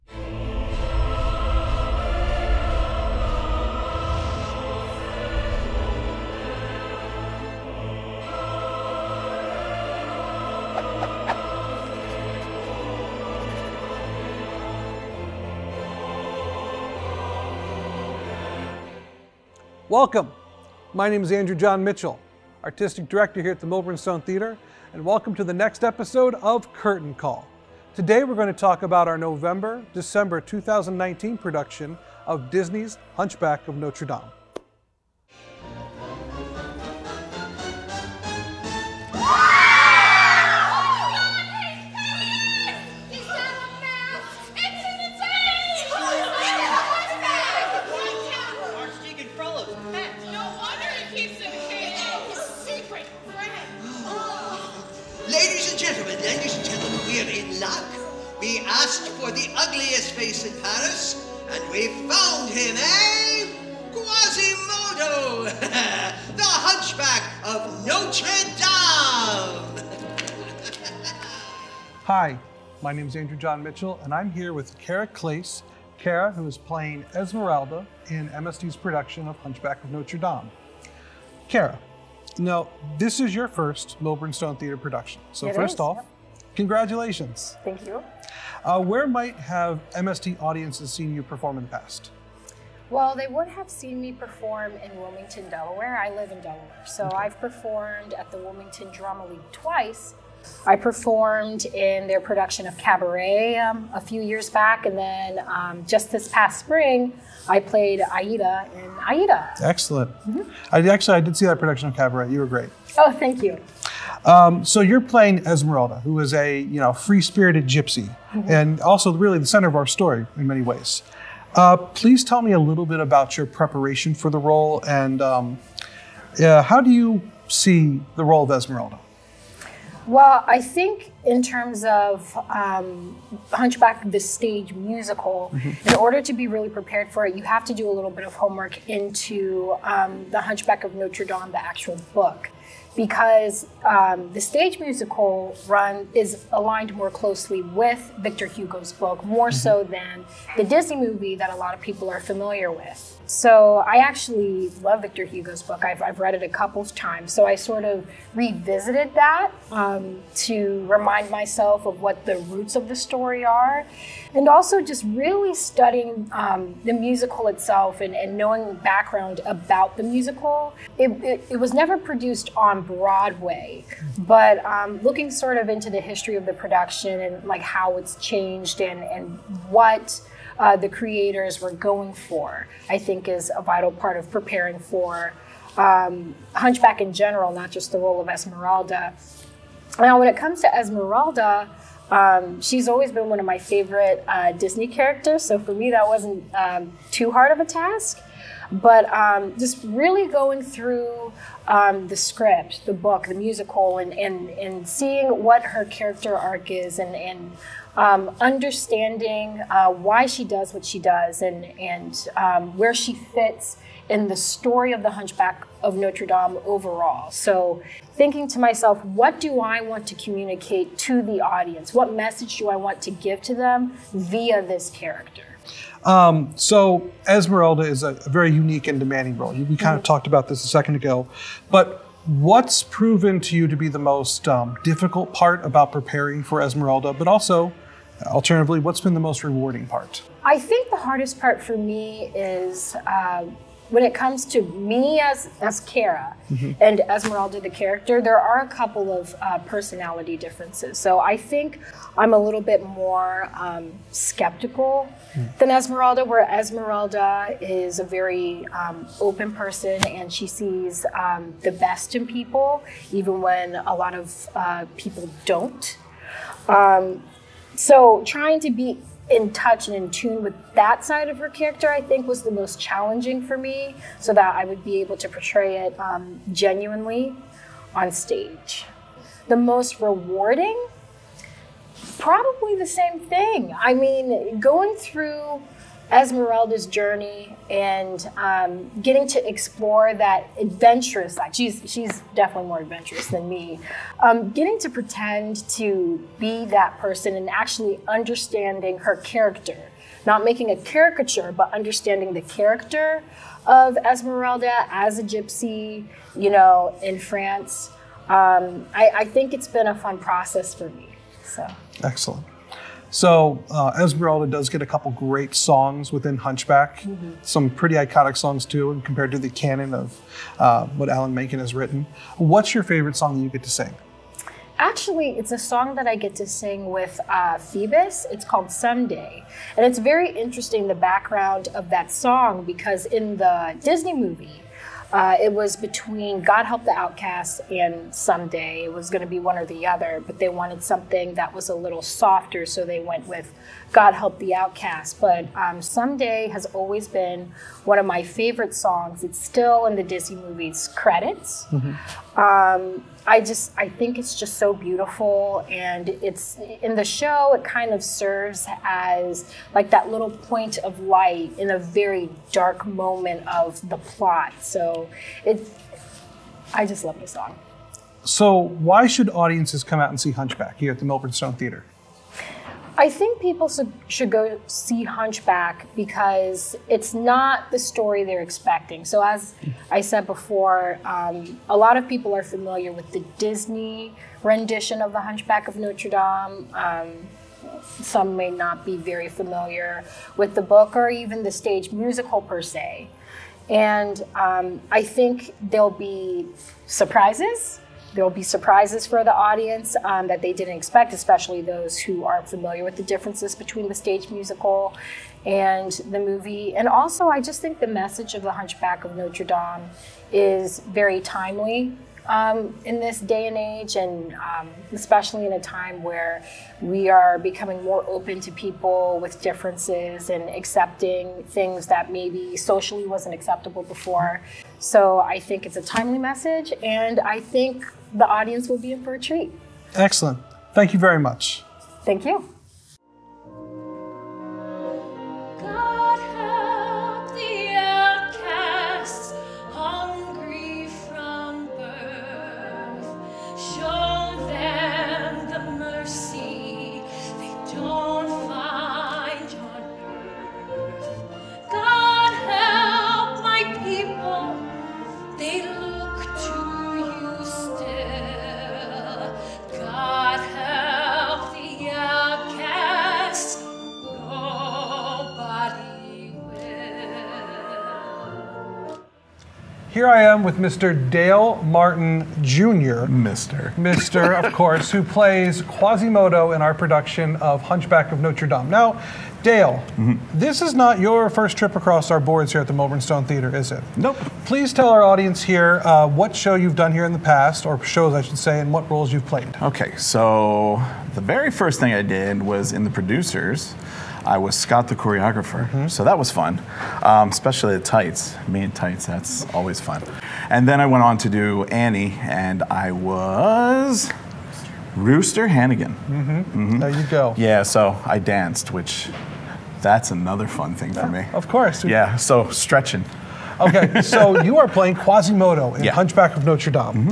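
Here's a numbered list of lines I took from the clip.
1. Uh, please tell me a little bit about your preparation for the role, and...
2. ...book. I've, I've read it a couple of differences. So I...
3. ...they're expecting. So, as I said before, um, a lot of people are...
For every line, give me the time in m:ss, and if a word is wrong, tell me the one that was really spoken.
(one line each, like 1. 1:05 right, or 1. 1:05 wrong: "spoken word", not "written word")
1. 2:01 right
2. 2:35 wrong: "times", not "differences"
3. 6:18 right.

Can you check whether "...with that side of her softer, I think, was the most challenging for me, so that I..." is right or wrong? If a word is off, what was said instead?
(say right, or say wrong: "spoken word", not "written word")
wrong: "character", not "softer".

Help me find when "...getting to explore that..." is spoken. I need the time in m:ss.
4:49.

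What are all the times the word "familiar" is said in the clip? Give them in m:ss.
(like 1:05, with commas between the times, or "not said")
2:32, 6:22, 6:29, 6:42.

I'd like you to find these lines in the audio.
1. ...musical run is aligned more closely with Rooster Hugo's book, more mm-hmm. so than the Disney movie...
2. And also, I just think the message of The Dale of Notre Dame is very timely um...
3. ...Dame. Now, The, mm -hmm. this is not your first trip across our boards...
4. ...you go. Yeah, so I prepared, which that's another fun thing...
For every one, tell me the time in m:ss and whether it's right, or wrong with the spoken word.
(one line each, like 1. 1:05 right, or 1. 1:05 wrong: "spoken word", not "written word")
1. 2:24 wrong: "Victor", not "Rooster"
2. 6:46 wrong: "Hunchback", not "Dale"
3. 7:58 wrong: "Dale", not "The"
4. 8:26 wrong: "danced", not "prepared".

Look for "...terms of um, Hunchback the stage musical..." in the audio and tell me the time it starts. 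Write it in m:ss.
2:11.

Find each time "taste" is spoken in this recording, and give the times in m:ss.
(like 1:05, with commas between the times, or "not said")
not said.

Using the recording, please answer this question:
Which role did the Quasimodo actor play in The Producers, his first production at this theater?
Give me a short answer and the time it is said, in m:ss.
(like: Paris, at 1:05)
Scott the choreographer, at 8:14.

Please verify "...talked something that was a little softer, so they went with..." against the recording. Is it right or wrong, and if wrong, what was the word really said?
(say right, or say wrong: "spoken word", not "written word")
wrong: "wanted", not "talked".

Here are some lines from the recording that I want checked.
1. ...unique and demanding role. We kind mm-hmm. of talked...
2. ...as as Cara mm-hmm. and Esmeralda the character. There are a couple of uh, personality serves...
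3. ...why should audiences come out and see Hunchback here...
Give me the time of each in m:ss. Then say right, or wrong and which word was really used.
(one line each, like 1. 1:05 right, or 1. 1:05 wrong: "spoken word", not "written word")
1. 3:48 right
2. 4:05 wrong: "differences", not "serves"
3. 6:08 right.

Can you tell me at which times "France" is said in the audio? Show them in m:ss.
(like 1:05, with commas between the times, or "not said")
5:07.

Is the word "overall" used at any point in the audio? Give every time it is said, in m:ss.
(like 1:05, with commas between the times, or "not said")
3:36.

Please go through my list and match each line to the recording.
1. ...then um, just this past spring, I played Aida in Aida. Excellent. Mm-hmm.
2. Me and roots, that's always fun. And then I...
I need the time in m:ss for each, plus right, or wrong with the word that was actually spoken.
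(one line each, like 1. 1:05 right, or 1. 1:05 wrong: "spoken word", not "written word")
1. 1:44 right
2. 8:18 wrong: "tights", not "roots".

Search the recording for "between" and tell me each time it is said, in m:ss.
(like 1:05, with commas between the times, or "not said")
5:35, 6:43.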